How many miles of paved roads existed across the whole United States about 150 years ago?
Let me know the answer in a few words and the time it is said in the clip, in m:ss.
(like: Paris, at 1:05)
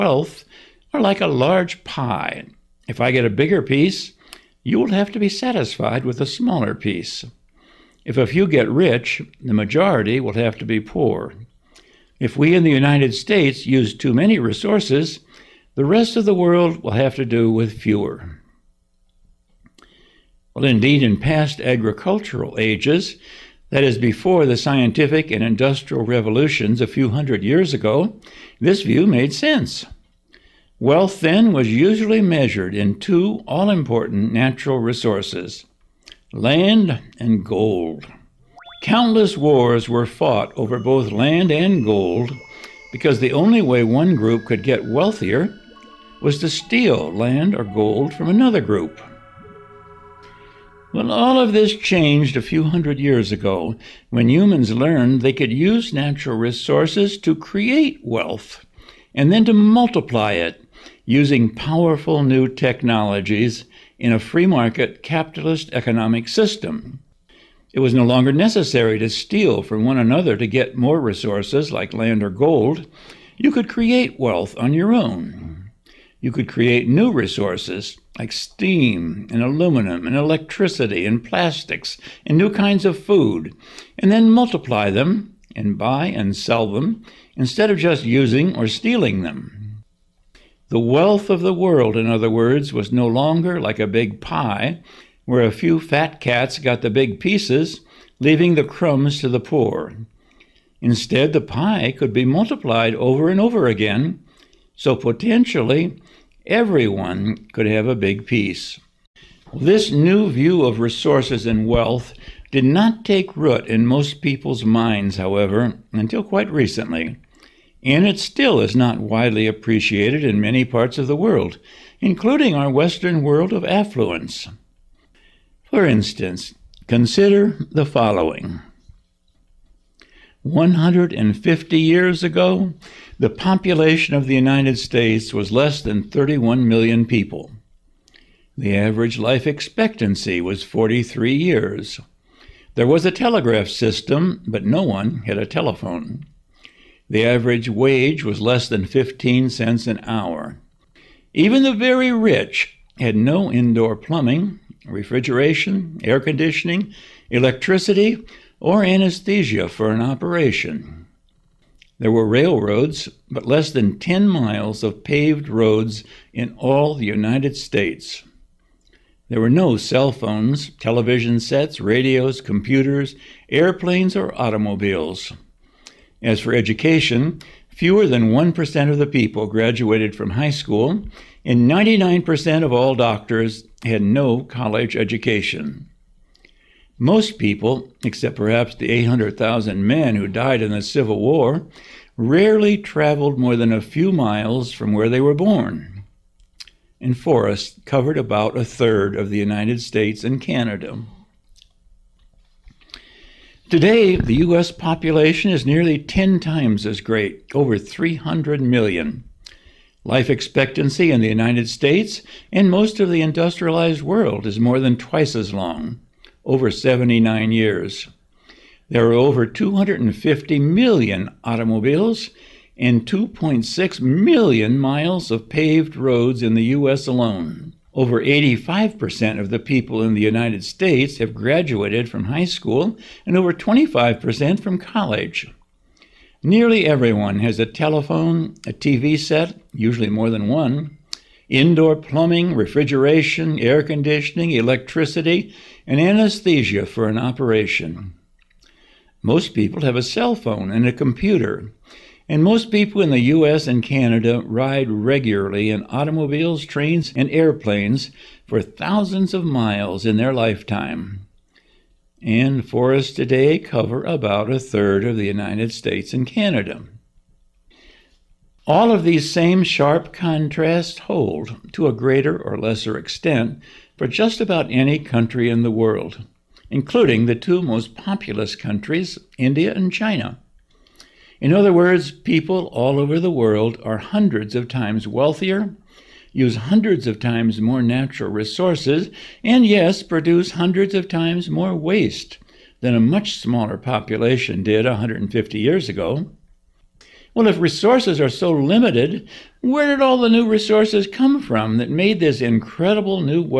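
less than 10 miles, at 2:43.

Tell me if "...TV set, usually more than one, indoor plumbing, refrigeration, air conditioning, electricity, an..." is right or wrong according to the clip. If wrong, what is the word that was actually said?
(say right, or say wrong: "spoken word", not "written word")
right.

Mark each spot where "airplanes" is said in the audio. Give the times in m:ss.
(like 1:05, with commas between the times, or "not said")
2:53, 4:17.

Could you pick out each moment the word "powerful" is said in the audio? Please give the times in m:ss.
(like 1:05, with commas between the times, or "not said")
1:01.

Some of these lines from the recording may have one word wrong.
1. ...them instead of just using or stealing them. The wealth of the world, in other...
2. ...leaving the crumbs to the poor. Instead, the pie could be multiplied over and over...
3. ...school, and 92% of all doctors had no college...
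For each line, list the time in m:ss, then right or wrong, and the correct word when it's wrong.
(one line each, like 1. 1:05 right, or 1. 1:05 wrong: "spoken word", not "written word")
1. 1:26 right
2. 1:38 right
3. 3:00 wrong: "99", not "92".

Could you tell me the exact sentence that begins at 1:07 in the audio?
It was no longer necessary to steal from one another to get more resources like land or gold.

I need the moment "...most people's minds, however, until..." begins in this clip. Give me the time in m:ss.
1:53.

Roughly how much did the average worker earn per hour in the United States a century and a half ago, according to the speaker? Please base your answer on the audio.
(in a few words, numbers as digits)
less than 15 cents.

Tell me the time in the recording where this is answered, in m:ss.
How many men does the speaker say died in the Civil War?
3:08.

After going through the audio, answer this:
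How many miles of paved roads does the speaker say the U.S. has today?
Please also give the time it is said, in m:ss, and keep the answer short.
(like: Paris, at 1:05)
2.6 million, at 3:43.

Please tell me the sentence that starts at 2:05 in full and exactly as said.
For instance, consider the following 150 years ago, the population of the United States was less than 31 million people.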